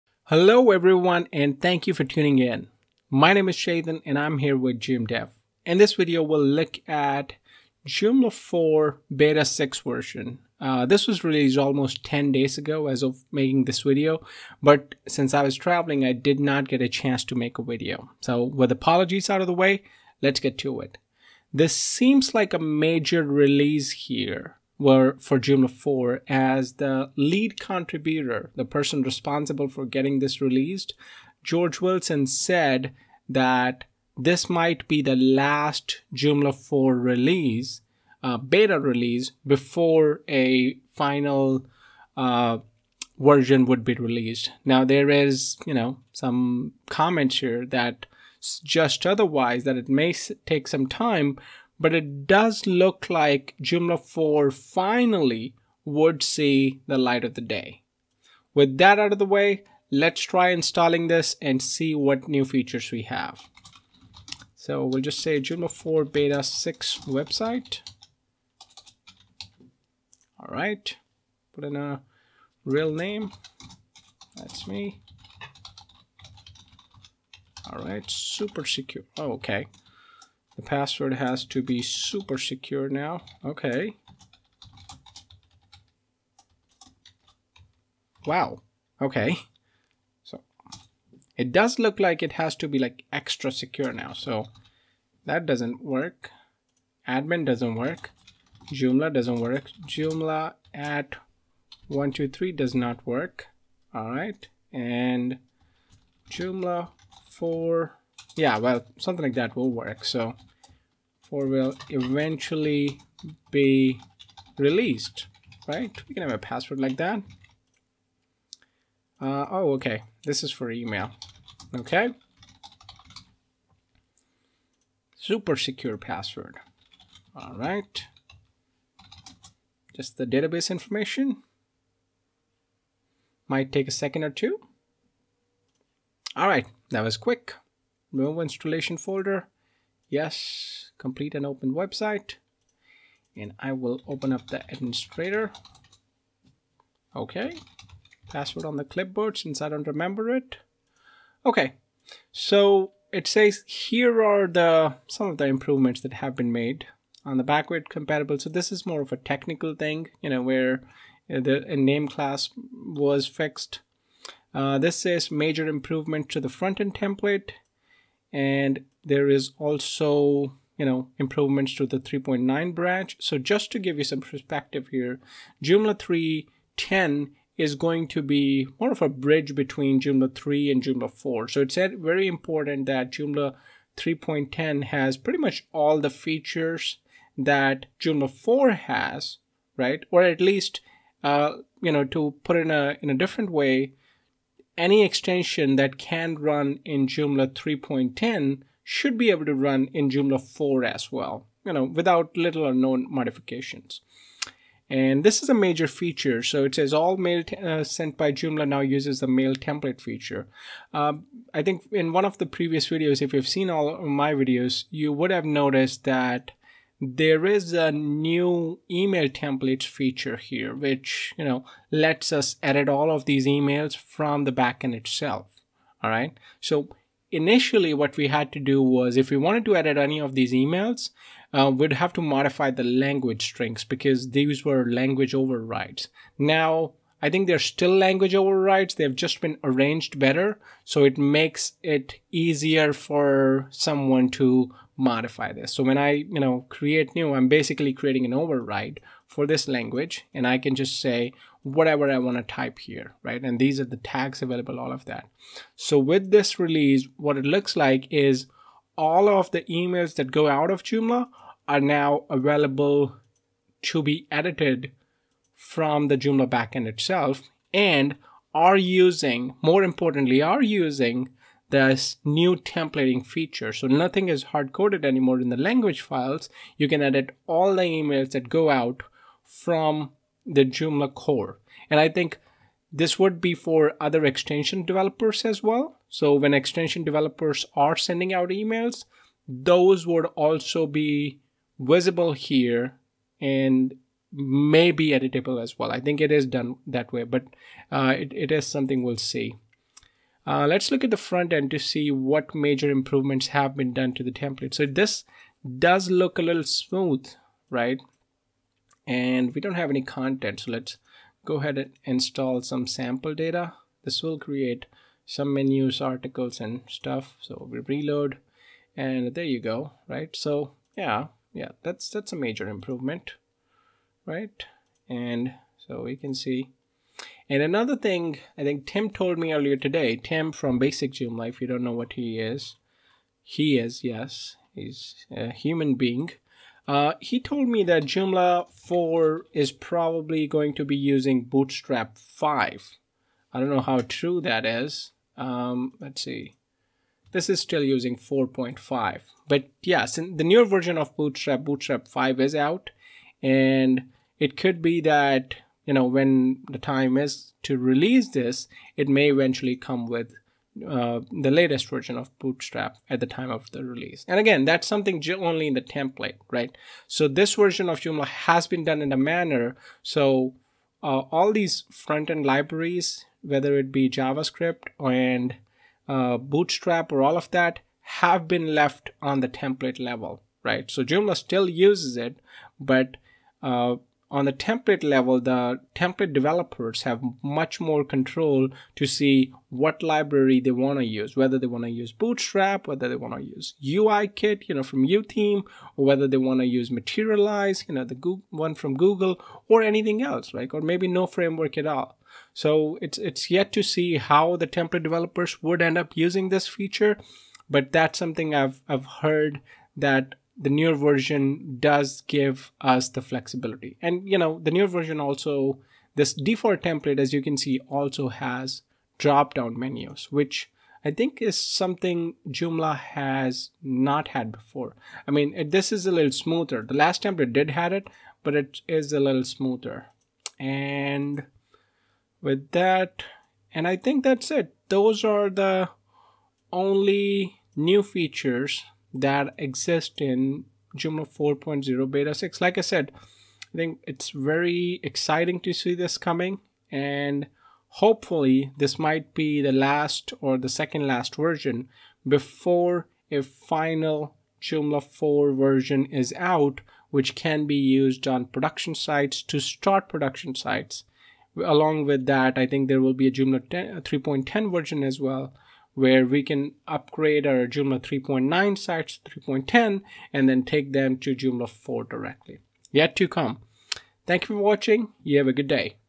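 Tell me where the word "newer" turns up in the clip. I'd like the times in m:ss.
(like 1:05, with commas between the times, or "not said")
5:50, 6:50, 6:54.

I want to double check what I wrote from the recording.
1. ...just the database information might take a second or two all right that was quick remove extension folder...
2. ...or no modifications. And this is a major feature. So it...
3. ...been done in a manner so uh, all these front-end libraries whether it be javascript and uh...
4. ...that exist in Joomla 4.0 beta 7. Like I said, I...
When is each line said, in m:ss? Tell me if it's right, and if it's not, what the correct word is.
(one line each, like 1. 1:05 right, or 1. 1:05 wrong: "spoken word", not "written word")
1. 2:09 wrong: "installation", not "extension"
2. 3:22 right
3. 6:08 right
4. 7:19 wrong: "6", not "7".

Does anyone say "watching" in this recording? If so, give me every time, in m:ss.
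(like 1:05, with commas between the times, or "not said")
7:54.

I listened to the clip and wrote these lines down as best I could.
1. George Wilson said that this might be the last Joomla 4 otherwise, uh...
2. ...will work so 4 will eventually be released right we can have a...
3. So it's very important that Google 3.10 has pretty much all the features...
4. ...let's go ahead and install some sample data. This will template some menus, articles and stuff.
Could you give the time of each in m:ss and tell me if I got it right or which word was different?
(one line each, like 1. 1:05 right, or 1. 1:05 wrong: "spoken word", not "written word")
1. 0:31 wrong: "release", not "otherwise"
2. 1:49 right
3. 3:01 wrong: "Joomla", not "Google"
4. 5:10 wrong: "create", not "template".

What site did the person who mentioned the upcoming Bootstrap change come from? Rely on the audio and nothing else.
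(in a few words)
Basic Gym Life.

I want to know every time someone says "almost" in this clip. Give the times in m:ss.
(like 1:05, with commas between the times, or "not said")
0:11.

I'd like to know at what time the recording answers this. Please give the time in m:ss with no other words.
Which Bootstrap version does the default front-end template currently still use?
5:48.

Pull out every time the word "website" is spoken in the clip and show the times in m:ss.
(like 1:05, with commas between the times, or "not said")
1:07, 2:21.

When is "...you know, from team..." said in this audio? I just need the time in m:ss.
6:34.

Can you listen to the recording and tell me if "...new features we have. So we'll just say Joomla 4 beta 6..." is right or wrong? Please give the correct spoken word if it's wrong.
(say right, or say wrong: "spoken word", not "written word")
right.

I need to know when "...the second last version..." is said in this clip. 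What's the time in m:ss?
7:30.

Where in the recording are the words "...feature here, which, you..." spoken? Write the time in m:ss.
3:39.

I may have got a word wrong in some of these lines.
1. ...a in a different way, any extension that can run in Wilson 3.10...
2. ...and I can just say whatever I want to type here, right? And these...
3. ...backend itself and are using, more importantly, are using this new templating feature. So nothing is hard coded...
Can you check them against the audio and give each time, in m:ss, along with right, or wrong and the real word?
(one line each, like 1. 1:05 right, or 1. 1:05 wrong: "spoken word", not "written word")
1. 3:12 wrong: "Joomla", not "Wilson"
2. 4:10 right
3. 4:26 right.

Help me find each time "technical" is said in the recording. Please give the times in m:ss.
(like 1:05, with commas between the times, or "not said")
2:39.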